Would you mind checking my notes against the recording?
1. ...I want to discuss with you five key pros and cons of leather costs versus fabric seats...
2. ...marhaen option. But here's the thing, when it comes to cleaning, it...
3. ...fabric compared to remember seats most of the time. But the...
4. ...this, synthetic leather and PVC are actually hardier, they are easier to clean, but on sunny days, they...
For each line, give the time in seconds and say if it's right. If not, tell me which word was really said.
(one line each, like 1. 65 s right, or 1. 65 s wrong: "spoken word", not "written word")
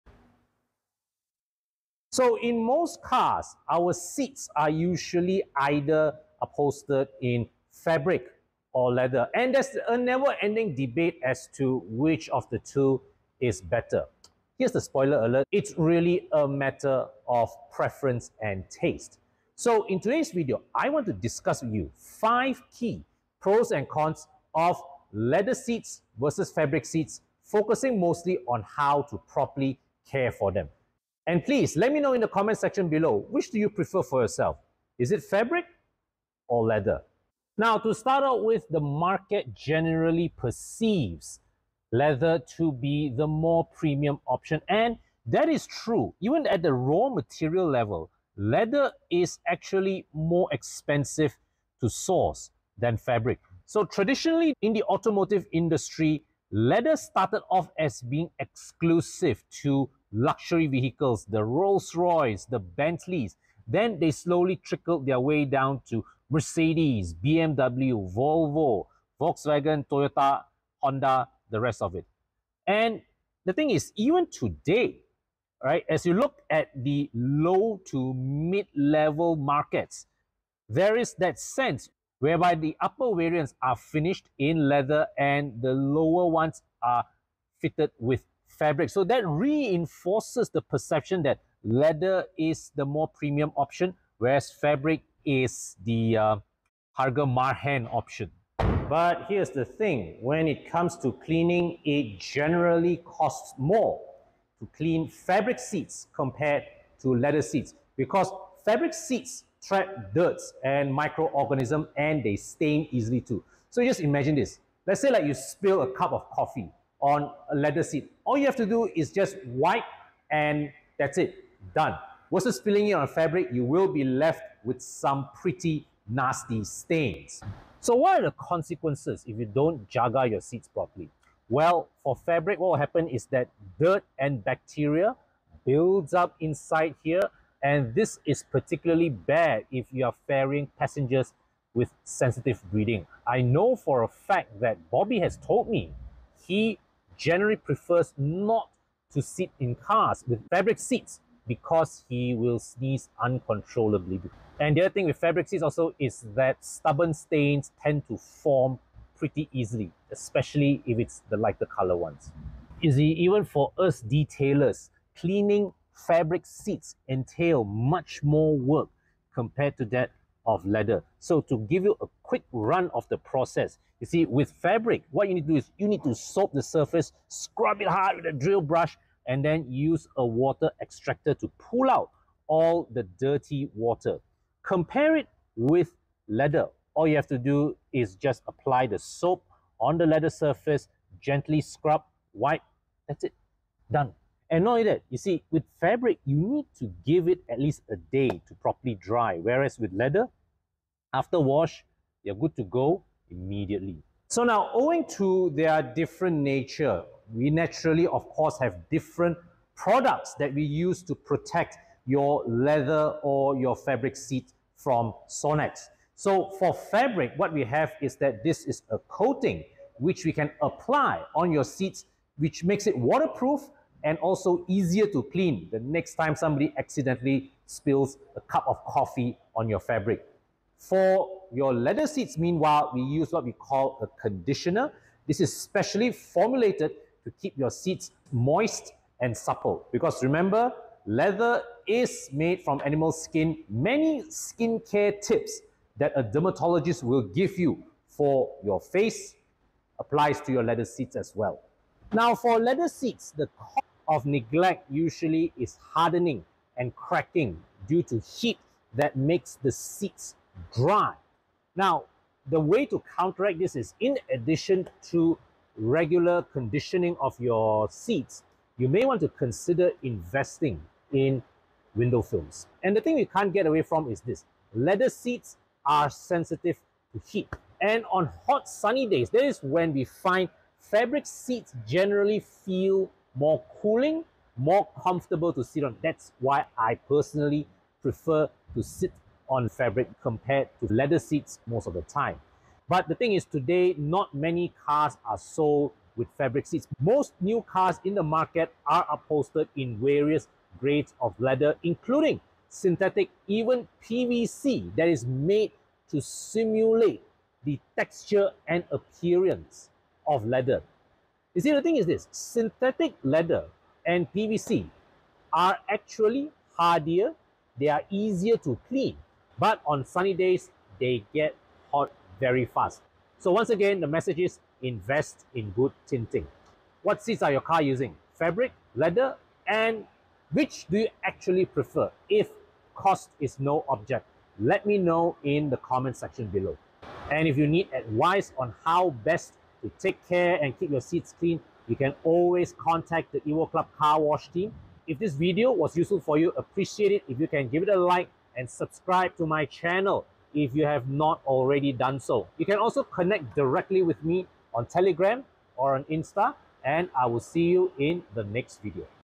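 1. 20 s wrong: "seats", not "costs"
2. 97 s right
3. 289 s wrong: "leather", not "remember"
4. 312 s right.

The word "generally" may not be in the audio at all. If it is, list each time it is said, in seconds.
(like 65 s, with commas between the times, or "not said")
39 s, 102 s, 147 s, 281 s.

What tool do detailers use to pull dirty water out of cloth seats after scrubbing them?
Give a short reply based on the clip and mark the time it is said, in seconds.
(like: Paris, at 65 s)
Water extractor, at 180 s.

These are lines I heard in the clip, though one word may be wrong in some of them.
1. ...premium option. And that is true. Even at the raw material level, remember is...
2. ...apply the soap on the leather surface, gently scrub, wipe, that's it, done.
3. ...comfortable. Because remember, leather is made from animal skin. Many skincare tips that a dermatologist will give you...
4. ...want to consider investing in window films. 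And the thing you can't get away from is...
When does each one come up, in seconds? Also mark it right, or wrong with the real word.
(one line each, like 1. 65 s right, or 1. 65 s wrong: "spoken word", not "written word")
1. 43 s wrong: "leather", not "remember"
2. 188 s right
3. 239 s wrong: "supple", not "comfortable"
4. 269 s right.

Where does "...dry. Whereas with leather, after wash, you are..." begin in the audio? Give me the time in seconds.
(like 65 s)
198 s.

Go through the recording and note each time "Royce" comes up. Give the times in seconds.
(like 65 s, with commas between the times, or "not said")
61 s.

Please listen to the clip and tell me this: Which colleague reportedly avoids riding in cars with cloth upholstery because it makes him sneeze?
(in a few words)
Bobby.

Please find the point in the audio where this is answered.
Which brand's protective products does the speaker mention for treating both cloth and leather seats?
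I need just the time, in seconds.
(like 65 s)
215 s.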